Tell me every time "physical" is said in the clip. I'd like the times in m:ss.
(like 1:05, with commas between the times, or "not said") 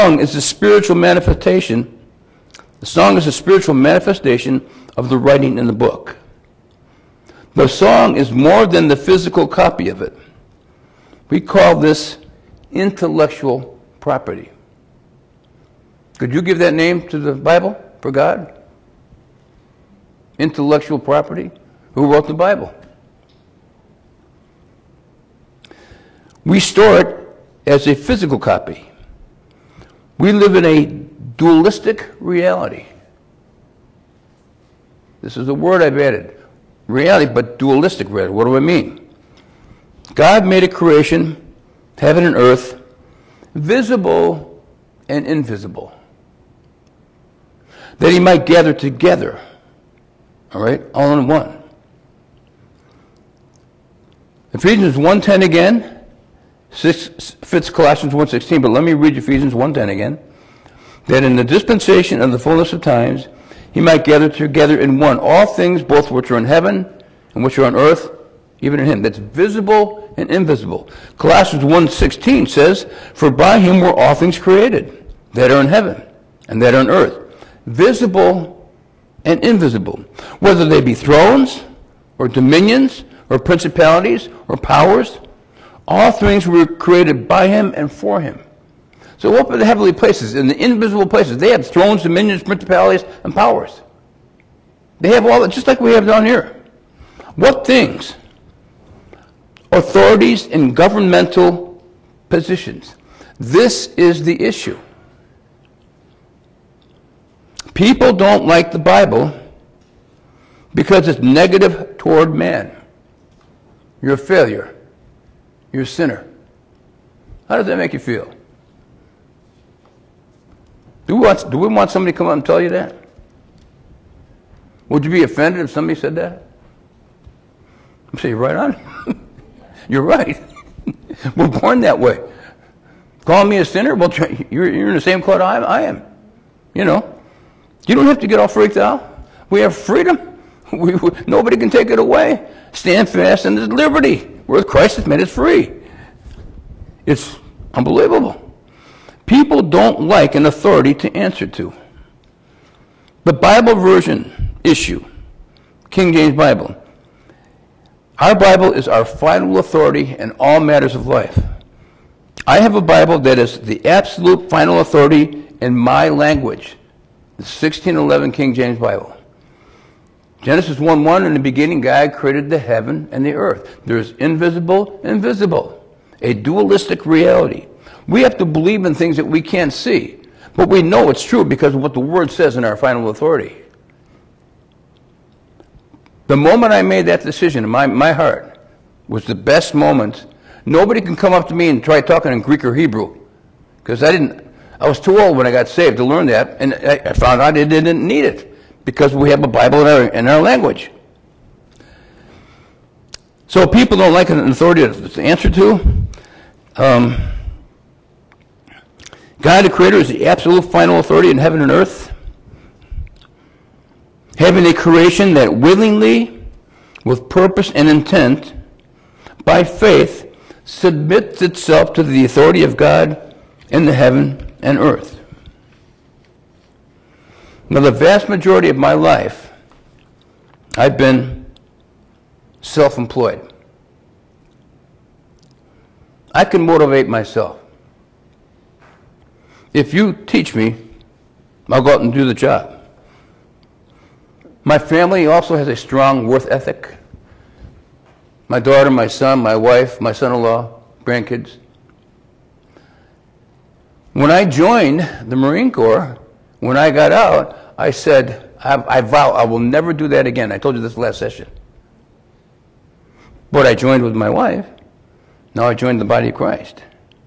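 0:08, 0:27.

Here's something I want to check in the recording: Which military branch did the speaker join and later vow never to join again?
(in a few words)
Marine Corps.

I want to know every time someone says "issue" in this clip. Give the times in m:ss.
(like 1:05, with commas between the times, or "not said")
1:44, 2:34.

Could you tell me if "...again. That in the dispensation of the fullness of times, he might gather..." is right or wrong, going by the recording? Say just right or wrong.
right.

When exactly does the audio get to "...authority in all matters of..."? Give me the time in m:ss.
2:39.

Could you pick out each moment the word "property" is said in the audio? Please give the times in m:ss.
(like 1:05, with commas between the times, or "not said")
0:13, 0:20.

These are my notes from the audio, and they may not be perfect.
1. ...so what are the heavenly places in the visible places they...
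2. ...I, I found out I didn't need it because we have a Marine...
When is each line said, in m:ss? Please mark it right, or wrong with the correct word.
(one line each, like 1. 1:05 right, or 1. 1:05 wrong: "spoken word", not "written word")
1. 1:29 wrong: "invisible", not "visible"
2. 3:16 wrong: "Bible", not "Marine".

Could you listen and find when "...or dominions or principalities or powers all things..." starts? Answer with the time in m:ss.
1:22.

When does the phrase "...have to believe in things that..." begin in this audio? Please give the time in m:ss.
2:58.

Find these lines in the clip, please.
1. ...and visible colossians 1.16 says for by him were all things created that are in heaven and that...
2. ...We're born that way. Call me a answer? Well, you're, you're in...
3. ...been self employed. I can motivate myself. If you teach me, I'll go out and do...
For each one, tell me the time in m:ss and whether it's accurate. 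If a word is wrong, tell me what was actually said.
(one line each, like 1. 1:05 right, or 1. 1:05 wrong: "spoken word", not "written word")
1. 1:10 wrong: "invisible", not "visible"
2. 2:11 wrong: "sinner", not "answer"
3. 3:50 right.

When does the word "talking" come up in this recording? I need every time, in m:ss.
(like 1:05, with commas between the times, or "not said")
3:12.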